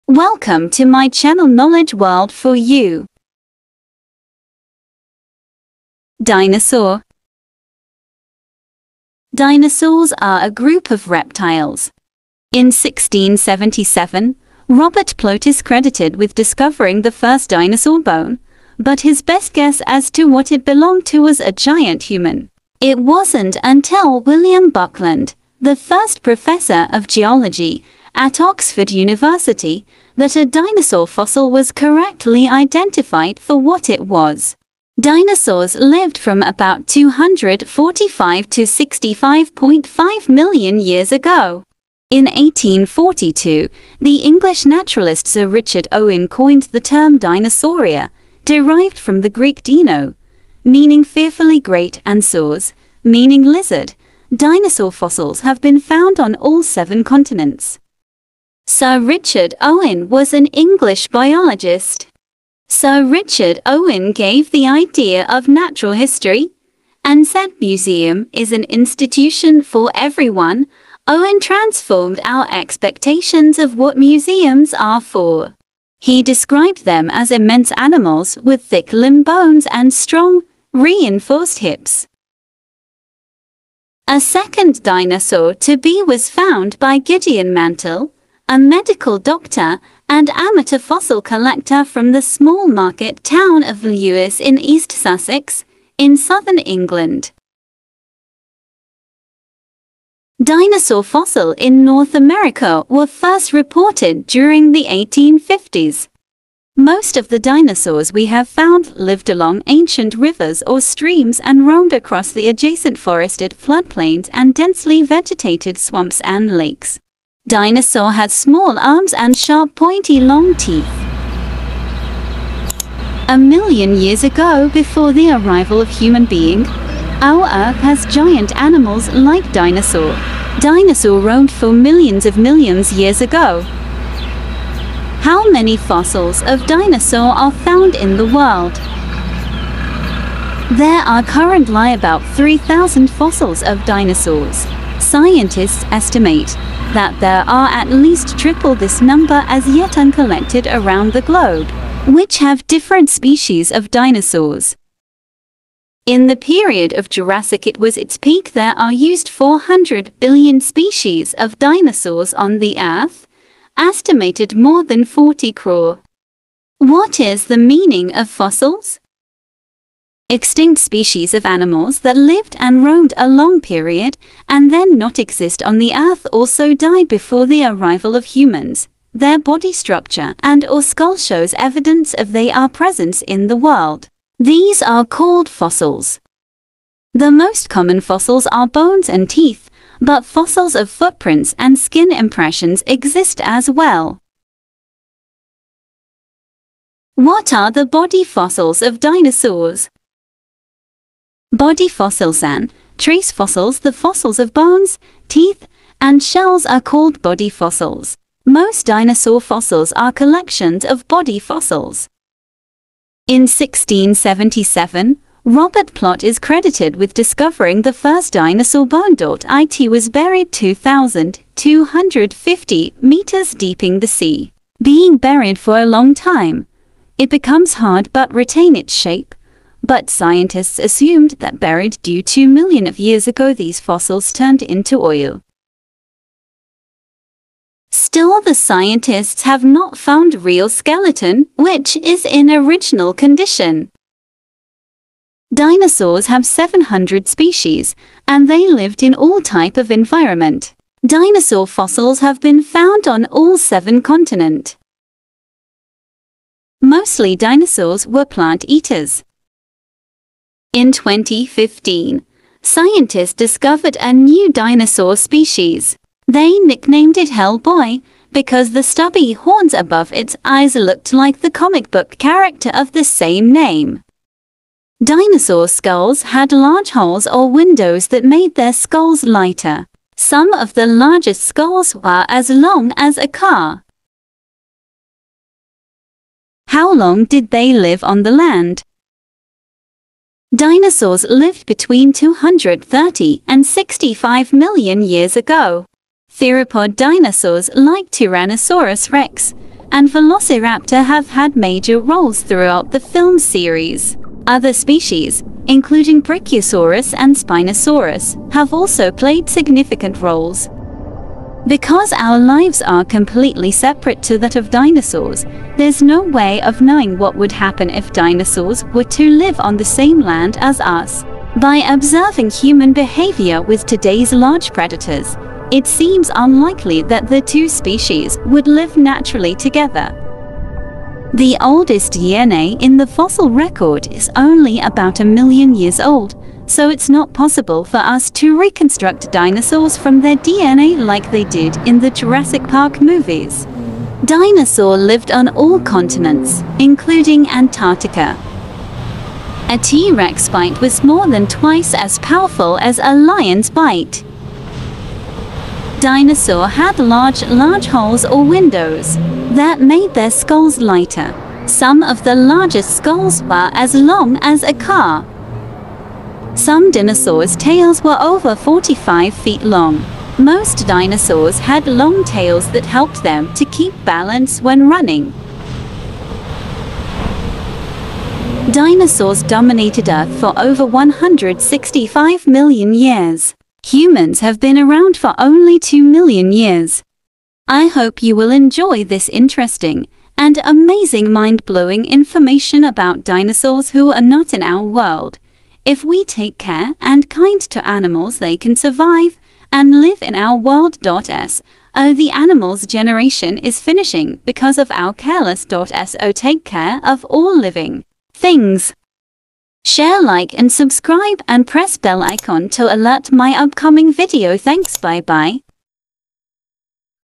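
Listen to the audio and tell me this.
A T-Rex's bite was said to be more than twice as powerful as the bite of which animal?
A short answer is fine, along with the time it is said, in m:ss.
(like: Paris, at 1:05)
Lion, at 5:53.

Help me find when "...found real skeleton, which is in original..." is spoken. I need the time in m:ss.
3:59.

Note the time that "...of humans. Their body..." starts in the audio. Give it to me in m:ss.
2:58.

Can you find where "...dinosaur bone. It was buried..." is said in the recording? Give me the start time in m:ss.
3:38.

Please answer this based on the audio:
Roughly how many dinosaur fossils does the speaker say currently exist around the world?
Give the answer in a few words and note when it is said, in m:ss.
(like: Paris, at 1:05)
3,000, at 2:22.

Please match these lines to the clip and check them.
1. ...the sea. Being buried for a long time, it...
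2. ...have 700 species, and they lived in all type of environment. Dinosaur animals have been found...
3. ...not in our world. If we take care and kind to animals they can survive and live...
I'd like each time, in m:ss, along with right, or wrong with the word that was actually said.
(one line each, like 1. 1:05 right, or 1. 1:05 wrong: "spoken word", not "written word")
1. 3:43 right
2. 4:06 wrong: "fossils", not "animals"
3. 6:34 right.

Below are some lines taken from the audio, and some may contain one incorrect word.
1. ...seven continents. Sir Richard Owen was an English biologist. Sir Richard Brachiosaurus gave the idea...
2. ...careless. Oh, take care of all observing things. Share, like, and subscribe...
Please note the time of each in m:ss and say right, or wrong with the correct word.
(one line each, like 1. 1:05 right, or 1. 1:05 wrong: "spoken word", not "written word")
1. 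0:56 wrong: "Owen", not "Brachiosaurus"
2. 6:45 wrong: "living", not "observing".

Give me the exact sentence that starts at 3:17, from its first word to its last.
What are the body fossils of dinosaurs?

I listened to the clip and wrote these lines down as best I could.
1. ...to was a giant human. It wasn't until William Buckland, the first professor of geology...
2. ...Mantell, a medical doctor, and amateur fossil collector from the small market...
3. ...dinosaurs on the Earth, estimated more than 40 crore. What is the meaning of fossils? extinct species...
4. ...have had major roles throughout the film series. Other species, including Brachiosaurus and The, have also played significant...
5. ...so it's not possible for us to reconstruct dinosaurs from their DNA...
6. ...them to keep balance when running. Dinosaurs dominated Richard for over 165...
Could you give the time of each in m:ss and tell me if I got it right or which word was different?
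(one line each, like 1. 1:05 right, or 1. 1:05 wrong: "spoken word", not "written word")
1. 0:21 right
2. 1:27 right
3. 2:41 right
4. 5:01 wrong: "Spinosaurus", not "The"
5. 5:36 right
6. 6:13 wrong: "Earth", not "Richard".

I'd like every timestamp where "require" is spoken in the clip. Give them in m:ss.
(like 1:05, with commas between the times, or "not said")
not said.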